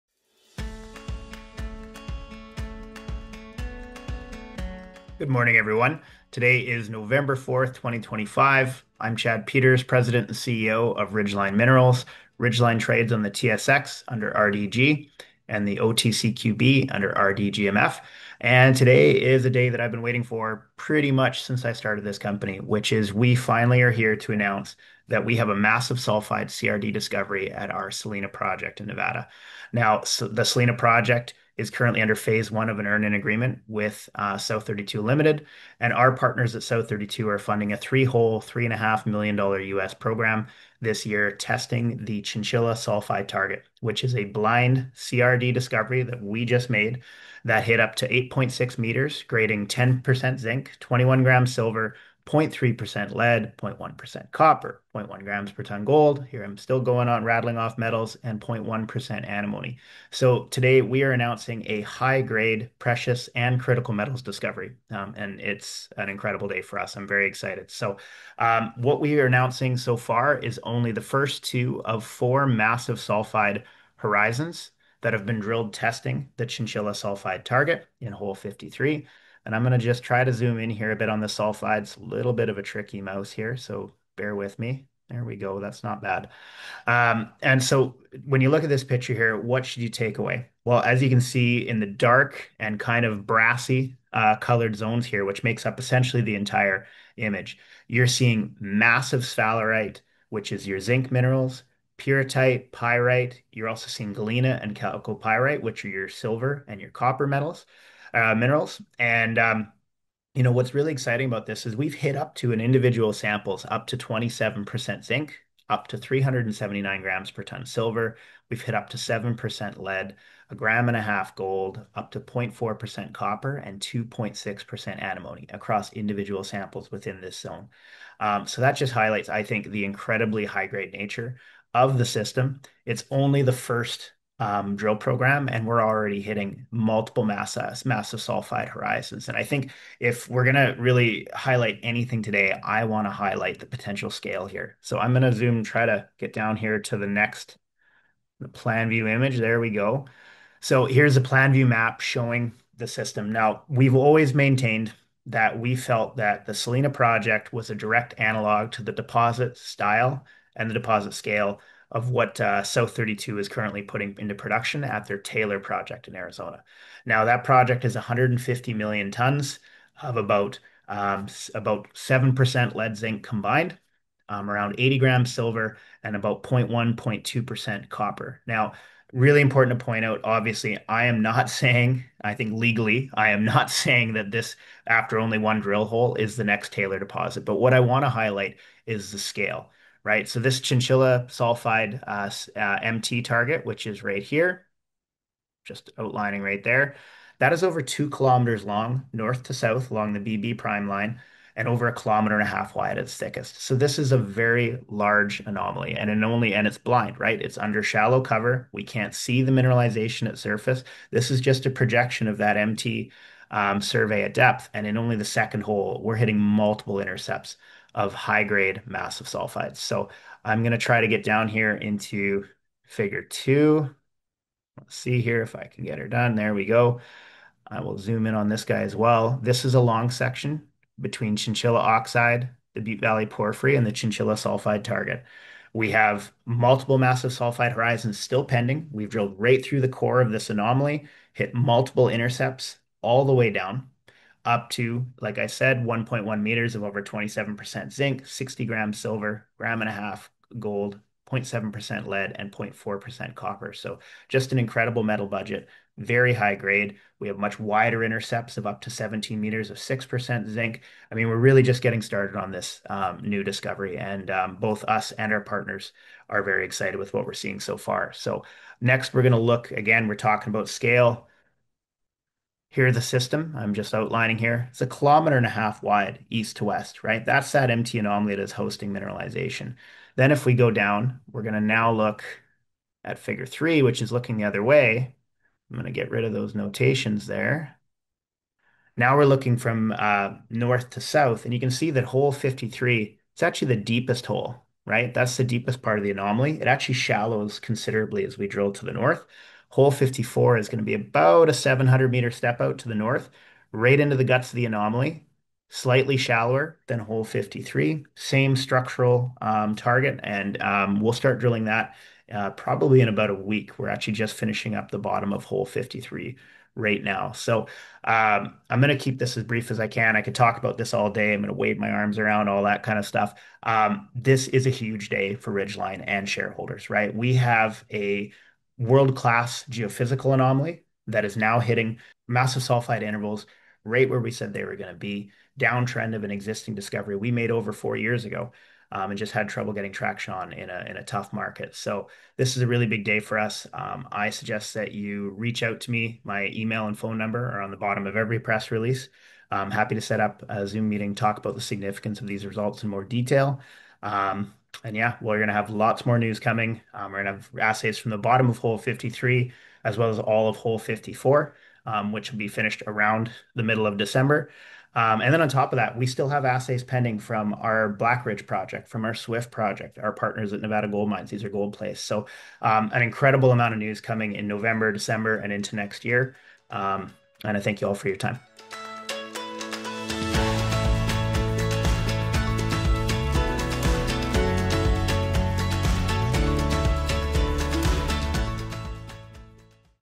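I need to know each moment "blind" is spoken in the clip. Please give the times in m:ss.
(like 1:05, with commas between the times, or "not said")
0:44, 3:26.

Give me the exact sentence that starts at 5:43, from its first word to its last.
Um, I suggest that you reach out to me.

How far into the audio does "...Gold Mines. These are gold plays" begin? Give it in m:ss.
6:10.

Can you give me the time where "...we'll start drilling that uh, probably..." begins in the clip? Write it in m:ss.
5:10.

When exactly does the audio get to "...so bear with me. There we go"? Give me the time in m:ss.
1:23.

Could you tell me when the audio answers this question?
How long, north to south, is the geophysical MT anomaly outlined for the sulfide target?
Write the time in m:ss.
3:17.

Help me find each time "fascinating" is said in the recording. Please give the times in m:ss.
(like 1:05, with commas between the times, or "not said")
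not said.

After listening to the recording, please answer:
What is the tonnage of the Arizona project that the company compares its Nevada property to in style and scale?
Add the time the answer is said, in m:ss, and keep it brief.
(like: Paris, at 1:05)
150 million tons, at 2:47.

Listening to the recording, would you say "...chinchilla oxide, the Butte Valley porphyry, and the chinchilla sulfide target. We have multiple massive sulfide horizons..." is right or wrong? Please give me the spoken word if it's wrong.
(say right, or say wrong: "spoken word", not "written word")
right.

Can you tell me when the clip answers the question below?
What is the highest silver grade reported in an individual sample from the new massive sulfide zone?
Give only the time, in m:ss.
1:55.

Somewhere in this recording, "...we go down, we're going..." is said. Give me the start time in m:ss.
4:40.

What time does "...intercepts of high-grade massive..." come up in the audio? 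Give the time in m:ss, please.
3:37.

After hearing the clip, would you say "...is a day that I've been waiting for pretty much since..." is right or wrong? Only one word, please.
right.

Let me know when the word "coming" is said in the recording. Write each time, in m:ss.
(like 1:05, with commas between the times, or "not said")
5:56, 6:14.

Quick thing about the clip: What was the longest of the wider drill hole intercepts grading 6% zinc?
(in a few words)
17 meters.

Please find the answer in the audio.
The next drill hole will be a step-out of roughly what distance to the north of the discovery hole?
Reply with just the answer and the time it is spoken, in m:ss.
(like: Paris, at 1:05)
700 meters, at 5:01.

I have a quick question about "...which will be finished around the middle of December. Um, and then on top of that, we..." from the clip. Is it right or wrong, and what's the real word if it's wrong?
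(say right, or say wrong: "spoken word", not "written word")
right.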